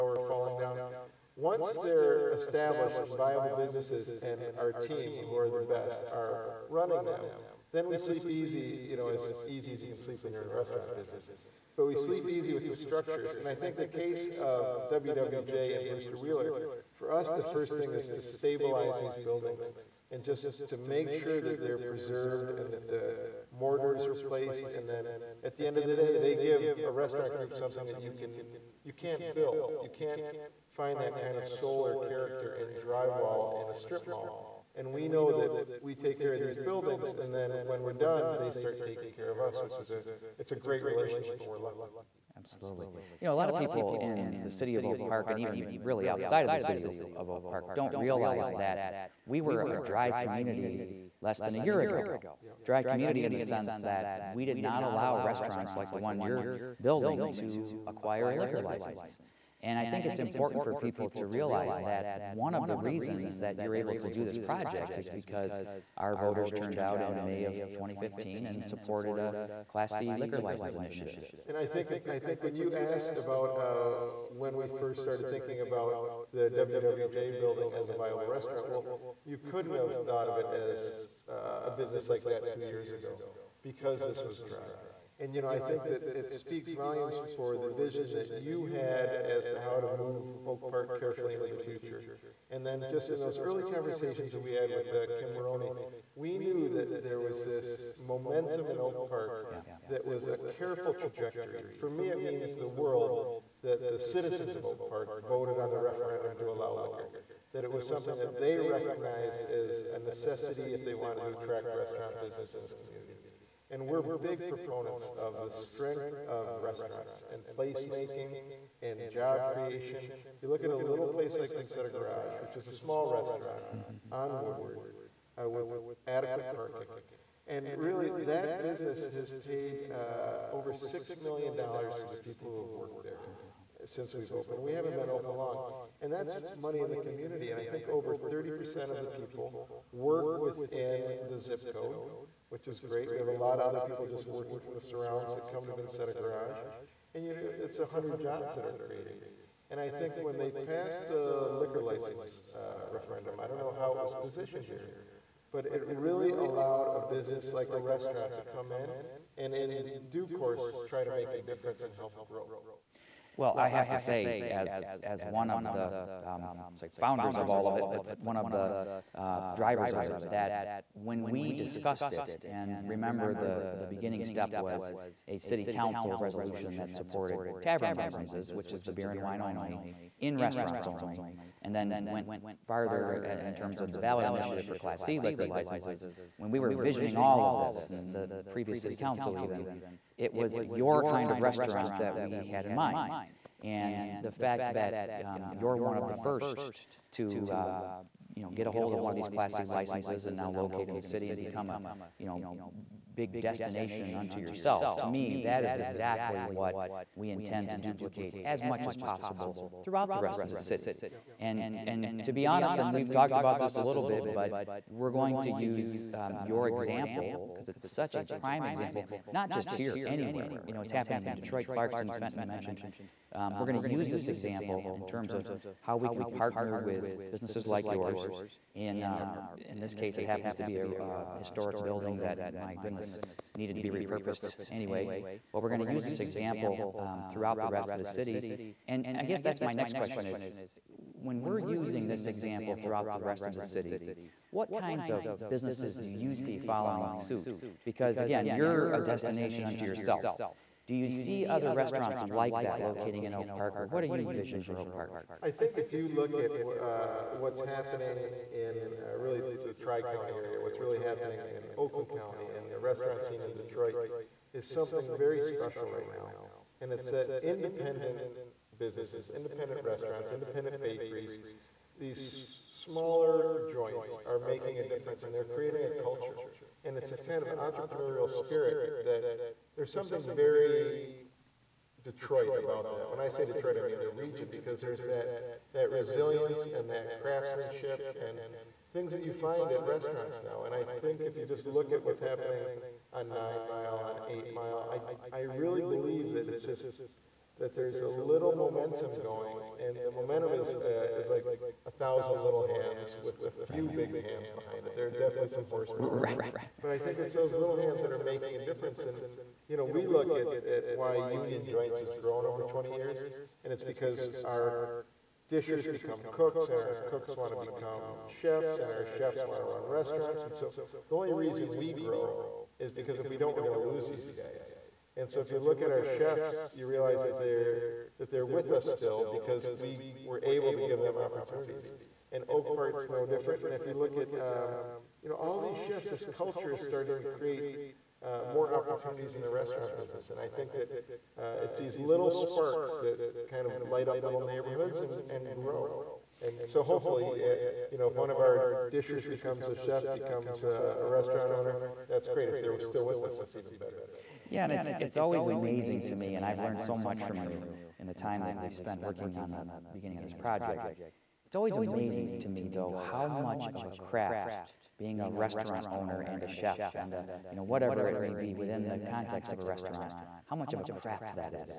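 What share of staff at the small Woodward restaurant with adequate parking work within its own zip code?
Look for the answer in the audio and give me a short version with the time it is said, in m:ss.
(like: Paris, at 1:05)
Over 30%, at 2:17.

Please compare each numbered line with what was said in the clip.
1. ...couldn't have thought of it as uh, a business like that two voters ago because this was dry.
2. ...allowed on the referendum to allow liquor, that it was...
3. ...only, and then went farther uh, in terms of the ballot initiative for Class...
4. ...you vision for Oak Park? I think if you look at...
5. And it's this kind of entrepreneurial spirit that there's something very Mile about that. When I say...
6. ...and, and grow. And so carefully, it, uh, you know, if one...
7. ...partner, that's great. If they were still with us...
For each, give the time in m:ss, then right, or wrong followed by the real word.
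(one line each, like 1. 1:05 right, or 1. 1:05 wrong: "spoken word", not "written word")
1. 1:19 wrong: "years", not "voters"
2. 1:45 wrong: "voted", not "allowed"
3. 3:00 right
4. 4:14 right
5. 4:36 wrong: "Detroit", not "Mile"
6. 5:45 wrong: "hopefully", not "carefully"
7. 5:51 wrong: "owner", not "partner".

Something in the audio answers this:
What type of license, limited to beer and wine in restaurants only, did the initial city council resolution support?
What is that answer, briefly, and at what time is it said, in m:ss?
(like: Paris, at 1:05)
Tavern licenses, at 2:57.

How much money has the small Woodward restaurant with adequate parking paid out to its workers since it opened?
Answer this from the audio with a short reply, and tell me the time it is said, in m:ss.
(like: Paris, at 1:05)
$6 million, at 2:10.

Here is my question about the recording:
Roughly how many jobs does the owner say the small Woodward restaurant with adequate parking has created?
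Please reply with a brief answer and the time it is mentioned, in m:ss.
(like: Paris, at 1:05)
100, at 2:27.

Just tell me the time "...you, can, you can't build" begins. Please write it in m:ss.
0:27.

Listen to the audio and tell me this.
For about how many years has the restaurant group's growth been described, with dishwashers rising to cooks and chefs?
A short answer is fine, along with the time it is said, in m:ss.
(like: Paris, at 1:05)
20 years, at 5:12.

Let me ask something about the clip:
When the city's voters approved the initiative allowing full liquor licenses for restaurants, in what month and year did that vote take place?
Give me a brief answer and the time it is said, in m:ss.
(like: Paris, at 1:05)
May 2015, at 1:07.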